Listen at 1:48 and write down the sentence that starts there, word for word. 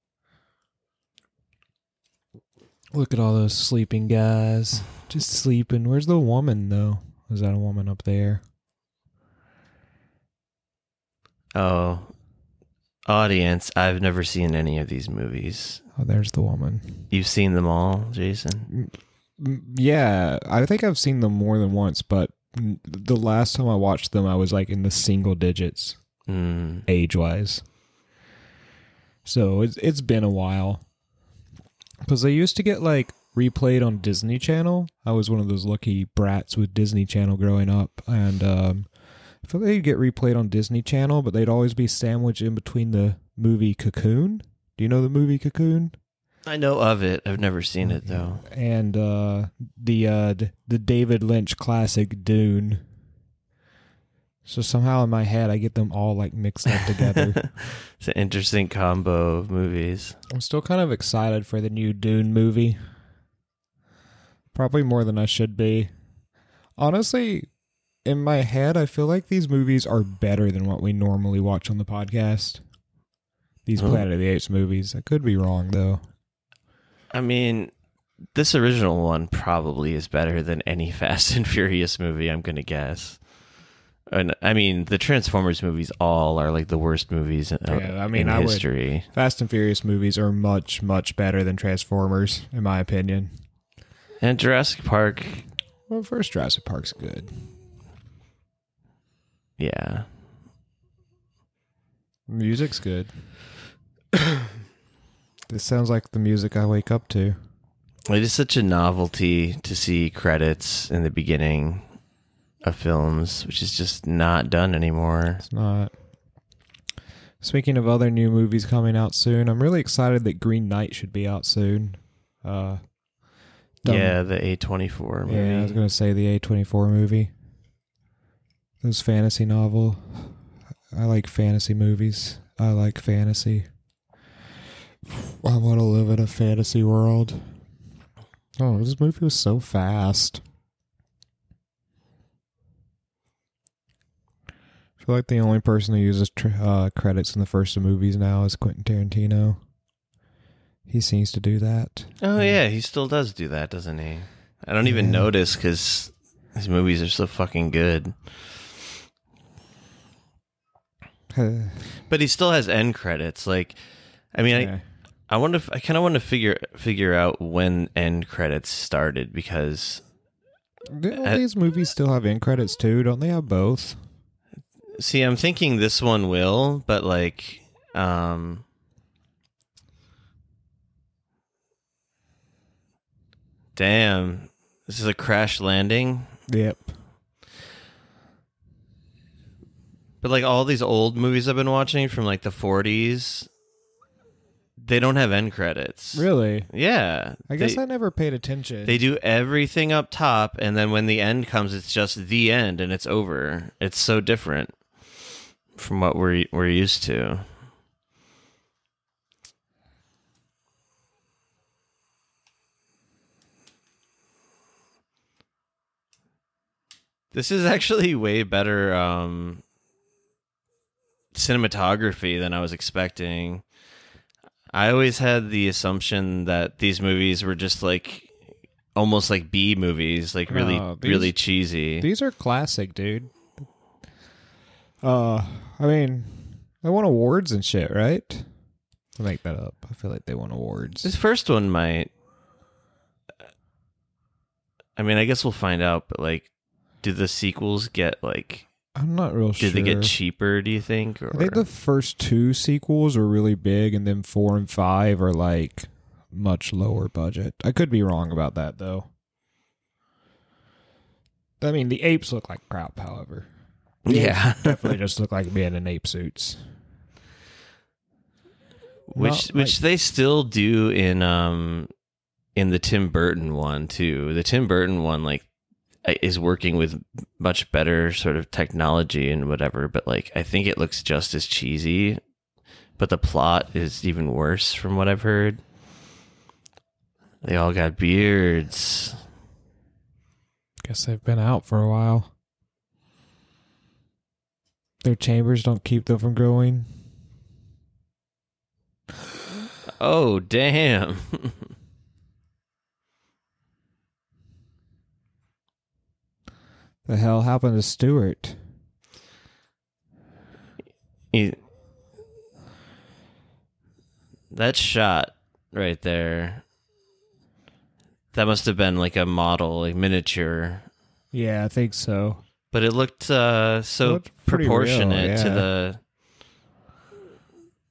It is such a novelty to see credits in the beginning of films, which is just not done anymore.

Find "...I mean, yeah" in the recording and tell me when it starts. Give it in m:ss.
2:44.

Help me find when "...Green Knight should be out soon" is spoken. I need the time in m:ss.
2:00.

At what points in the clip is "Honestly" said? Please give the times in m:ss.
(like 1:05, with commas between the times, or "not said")
1:06.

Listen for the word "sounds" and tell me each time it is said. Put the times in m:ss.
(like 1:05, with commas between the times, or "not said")
1:45.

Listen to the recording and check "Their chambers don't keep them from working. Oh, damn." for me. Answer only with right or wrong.
wrong.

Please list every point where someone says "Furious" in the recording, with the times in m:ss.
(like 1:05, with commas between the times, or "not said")
1:21, 1:29.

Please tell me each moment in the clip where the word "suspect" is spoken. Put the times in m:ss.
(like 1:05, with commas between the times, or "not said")
not said.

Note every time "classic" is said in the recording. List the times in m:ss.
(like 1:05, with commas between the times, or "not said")
0:51, 3:52.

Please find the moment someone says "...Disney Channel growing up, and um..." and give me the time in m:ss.
0:36.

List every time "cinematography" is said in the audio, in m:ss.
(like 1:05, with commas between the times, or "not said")
3:41.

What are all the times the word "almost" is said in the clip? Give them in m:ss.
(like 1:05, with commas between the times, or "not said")
3:48.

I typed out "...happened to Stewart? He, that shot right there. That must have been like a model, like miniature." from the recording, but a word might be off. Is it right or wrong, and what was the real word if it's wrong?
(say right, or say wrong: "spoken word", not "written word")
right.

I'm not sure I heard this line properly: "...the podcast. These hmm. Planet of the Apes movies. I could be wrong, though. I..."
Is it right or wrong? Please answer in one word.
right.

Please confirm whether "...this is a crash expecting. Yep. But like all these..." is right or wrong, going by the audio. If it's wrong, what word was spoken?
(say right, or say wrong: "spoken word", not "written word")
wrong: "landing", not "expecting".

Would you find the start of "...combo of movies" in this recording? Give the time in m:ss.
0:58.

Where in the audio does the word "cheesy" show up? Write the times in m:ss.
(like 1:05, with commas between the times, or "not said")
3:51, 4:41.